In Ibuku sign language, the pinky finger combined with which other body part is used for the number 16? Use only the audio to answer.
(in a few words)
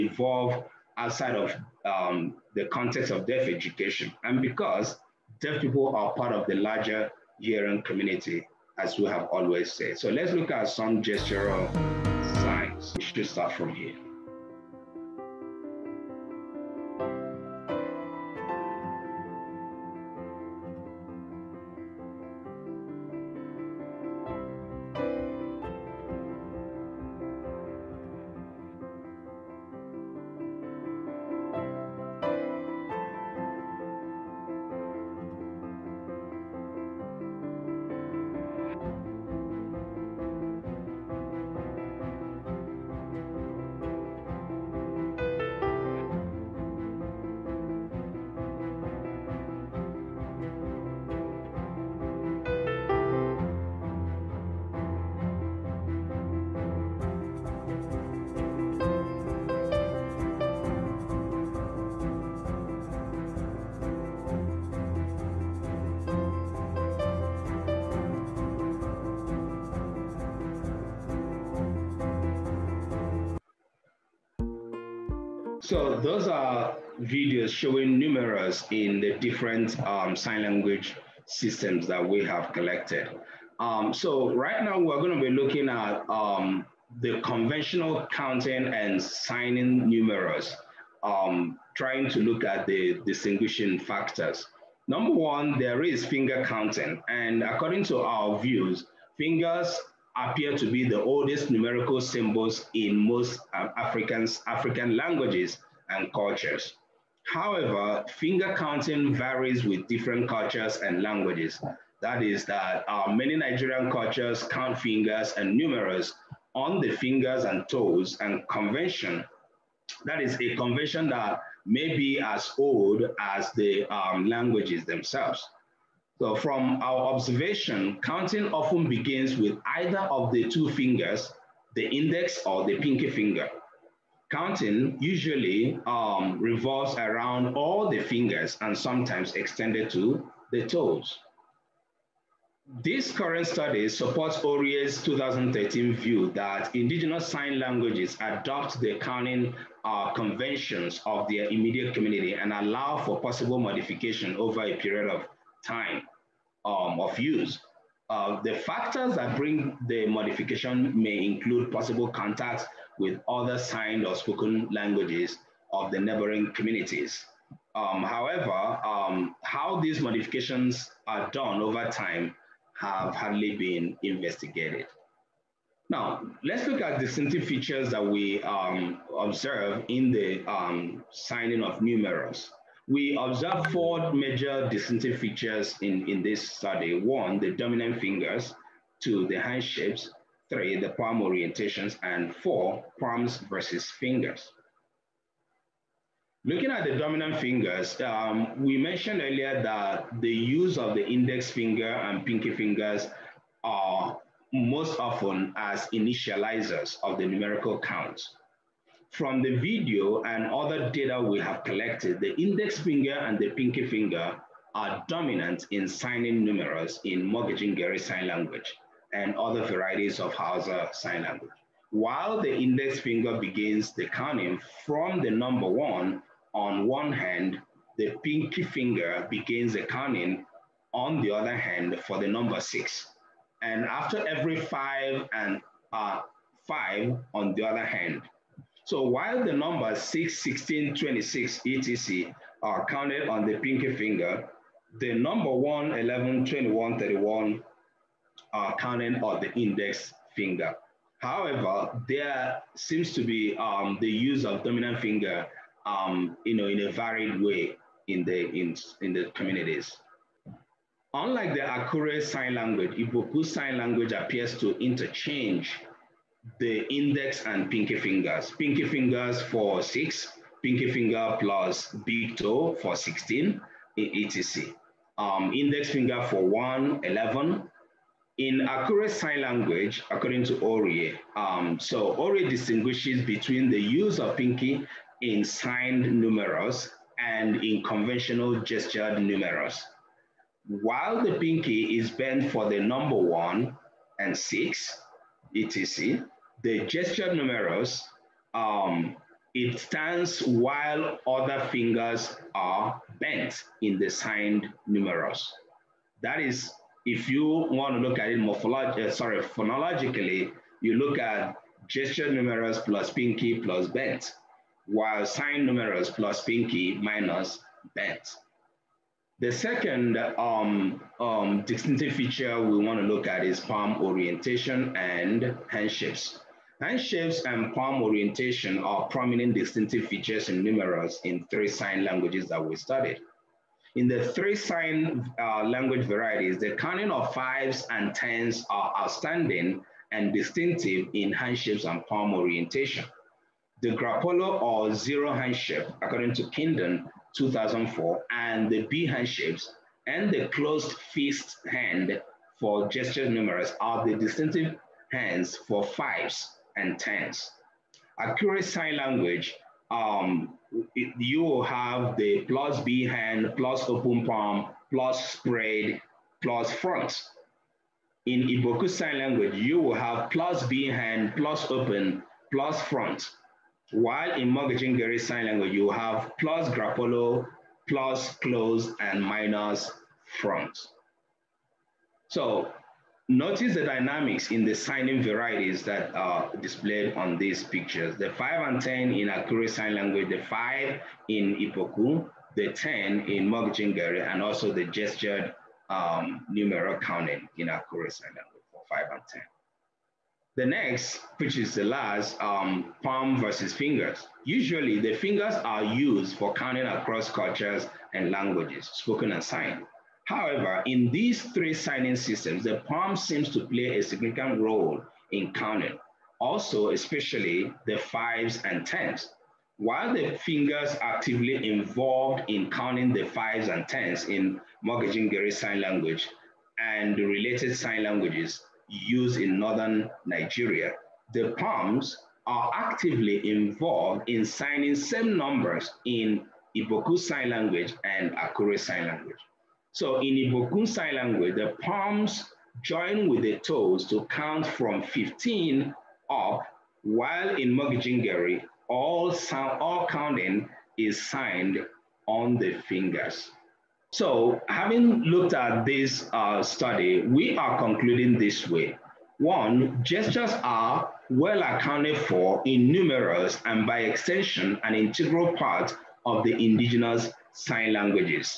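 Big toe.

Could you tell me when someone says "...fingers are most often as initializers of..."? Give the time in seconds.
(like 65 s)
202 s.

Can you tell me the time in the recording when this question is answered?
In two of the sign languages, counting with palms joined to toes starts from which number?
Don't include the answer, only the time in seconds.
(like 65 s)
445 s.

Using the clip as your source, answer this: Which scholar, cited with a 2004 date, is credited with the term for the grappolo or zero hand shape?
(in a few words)
Kendon.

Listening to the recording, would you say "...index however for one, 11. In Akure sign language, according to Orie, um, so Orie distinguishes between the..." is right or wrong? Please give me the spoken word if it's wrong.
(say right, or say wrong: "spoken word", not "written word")
wrong: "finger", not "however".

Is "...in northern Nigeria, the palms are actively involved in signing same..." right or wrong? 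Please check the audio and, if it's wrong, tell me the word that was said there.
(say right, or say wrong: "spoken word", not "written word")
right.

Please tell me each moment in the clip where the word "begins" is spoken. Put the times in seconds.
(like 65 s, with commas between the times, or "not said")
128 s, 223 s, 229 s.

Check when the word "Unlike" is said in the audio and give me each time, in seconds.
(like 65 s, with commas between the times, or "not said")
261 s.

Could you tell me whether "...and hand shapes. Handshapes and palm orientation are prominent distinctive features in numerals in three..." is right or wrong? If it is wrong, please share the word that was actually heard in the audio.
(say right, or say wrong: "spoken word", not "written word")
right.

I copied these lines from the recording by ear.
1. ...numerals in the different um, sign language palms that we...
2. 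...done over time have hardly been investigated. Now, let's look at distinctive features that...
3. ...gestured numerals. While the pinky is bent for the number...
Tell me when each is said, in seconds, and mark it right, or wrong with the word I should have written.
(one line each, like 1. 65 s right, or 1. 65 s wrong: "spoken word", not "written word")
1. 77 s wrong: "systems", not "palms"
2. 171 s right
3. 288 s right.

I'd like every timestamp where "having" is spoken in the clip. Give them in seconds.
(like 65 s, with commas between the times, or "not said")
454 s.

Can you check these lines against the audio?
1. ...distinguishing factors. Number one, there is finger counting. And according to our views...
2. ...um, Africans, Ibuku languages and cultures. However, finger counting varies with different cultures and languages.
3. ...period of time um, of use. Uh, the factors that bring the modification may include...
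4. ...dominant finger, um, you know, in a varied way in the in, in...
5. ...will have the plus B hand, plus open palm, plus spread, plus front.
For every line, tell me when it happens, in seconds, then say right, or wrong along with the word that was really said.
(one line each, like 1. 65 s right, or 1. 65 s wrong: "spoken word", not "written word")
1. 93 s right
2. 103 s wrong: "African", not "Ibuku"
3. 154 s right
4. 254 s right
5. 361 s right.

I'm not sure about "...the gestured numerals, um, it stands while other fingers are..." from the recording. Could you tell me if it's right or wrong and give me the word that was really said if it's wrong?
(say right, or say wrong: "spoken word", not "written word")
right.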